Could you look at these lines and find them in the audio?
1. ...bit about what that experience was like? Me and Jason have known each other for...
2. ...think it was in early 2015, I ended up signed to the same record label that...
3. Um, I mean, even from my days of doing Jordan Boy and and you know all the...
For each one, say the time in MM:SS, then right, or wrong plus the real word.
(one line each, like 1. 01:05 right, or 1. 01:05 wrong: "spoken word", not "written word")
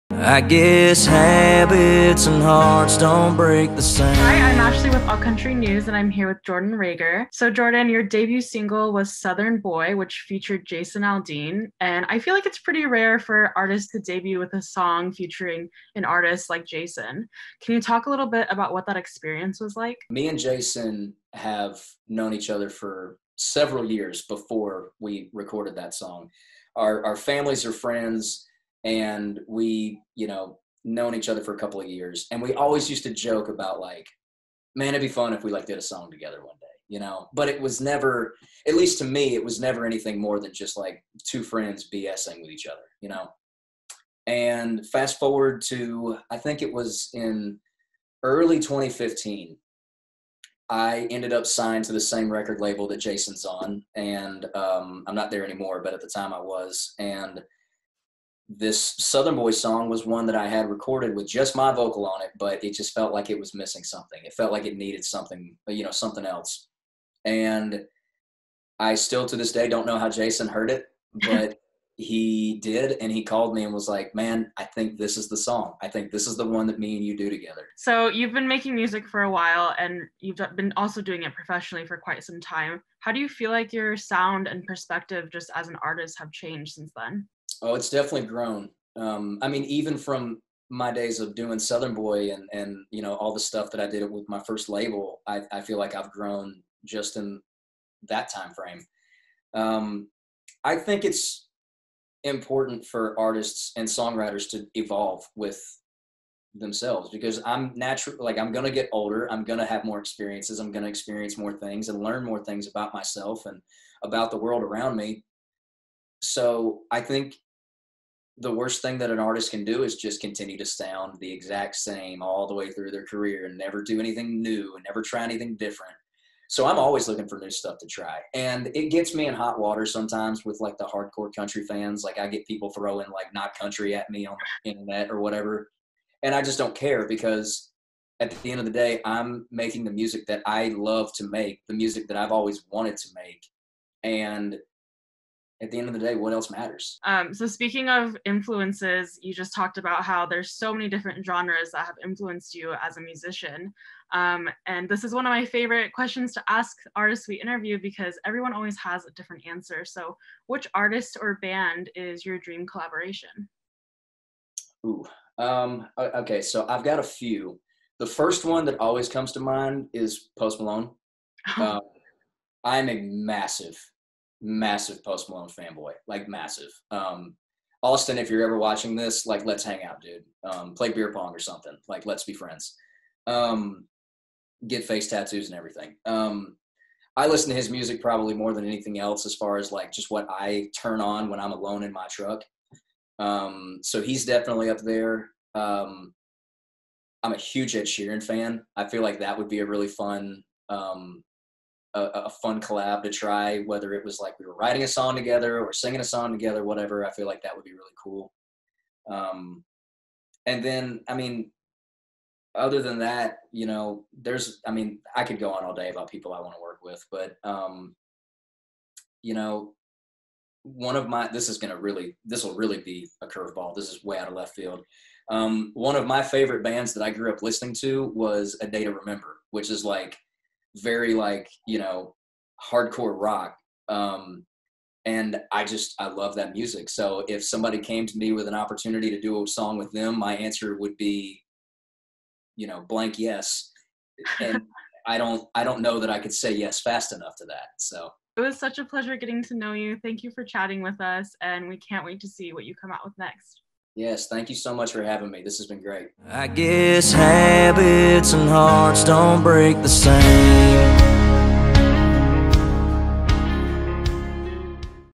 1. 00:18 right
2. 00:46 right
3. 01:28 wrong: "Southern", not "Jordan".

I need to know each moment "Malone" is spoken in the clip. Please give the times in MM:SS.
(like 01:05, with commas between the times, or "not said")
02:50, 02:55.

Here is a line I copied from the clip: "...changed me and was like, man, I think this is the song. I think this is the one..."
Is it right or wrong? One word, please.
wrong.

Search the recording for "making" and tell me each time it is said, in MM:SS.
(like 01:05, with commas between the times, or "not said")
01:18, 02:19.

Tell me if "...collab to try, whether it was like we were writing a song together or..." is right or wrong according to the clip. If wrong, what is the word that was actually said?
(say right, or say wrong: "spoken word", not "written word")
right.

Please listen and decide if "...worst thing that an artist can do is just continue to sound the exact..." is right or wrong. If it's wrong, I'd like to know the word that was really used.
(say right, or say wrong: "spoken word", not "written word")
right.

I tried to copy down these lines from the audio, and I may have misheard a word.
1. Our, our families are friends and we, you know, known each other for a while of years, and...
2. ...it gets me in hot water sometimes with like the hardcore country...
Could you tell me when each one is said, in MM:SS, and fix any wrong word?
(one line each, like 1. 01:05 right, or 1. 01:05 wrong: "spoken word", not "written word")
1. 00:26 wrong: "couple", not "while"
2. 02:08 right.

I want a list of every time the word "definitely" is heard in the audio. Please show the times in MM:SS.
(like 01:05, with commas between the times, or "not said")
01:27, 03:14.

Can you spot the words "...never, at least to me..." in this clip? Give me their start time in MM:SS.
00:37.